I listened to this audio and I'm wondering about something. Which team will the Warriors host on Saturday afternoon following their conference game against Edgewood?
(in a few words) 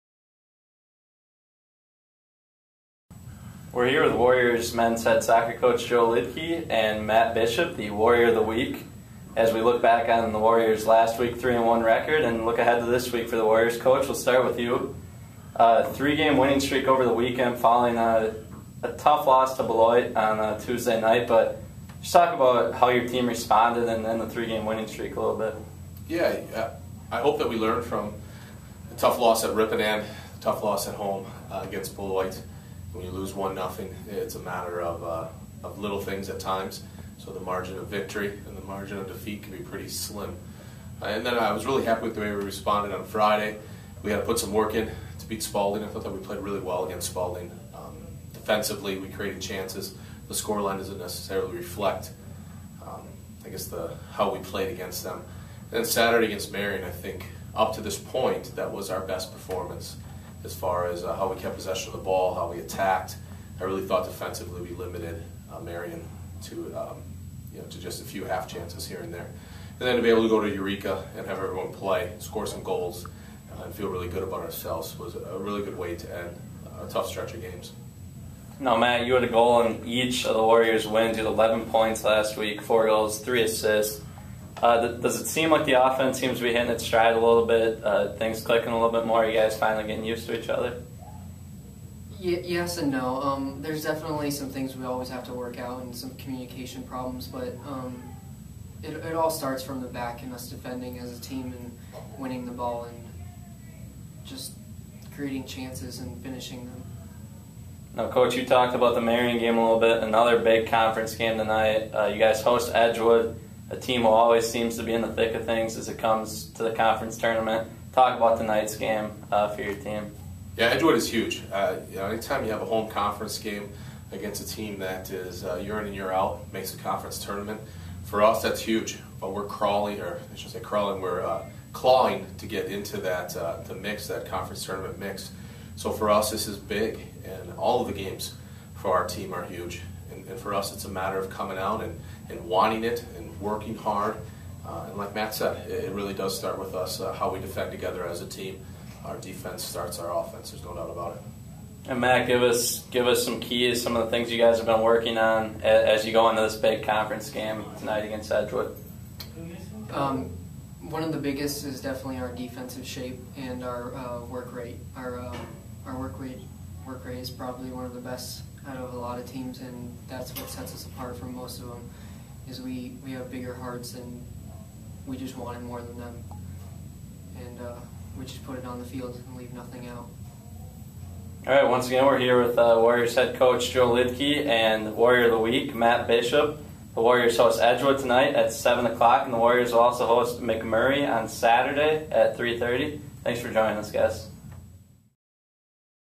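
MacMurray.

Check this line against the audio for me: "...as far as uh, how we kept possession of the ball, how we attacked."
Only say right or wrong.
right.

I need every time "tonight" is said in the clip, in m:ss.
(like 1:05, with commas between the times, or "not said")
1:51, 1:58, 2:37, 3:07.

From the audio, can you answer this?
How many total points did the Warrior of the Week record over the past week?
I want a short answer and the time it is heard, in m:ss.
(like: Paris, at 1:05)
11, at 1:21.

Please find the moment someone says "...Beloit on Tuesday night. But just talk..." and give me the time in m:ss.
0:19.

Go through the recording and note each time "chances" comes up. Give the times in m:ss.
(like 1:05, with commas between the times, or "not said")
0:49, 1:08, 1:45.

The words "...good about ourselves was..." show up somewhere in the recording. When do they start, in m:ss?
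1:14.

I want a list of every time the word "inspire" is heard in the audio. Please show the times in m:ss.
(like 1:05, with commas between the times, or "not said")
not said.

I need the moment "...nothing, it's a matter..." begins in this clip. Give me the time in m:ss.
0:33.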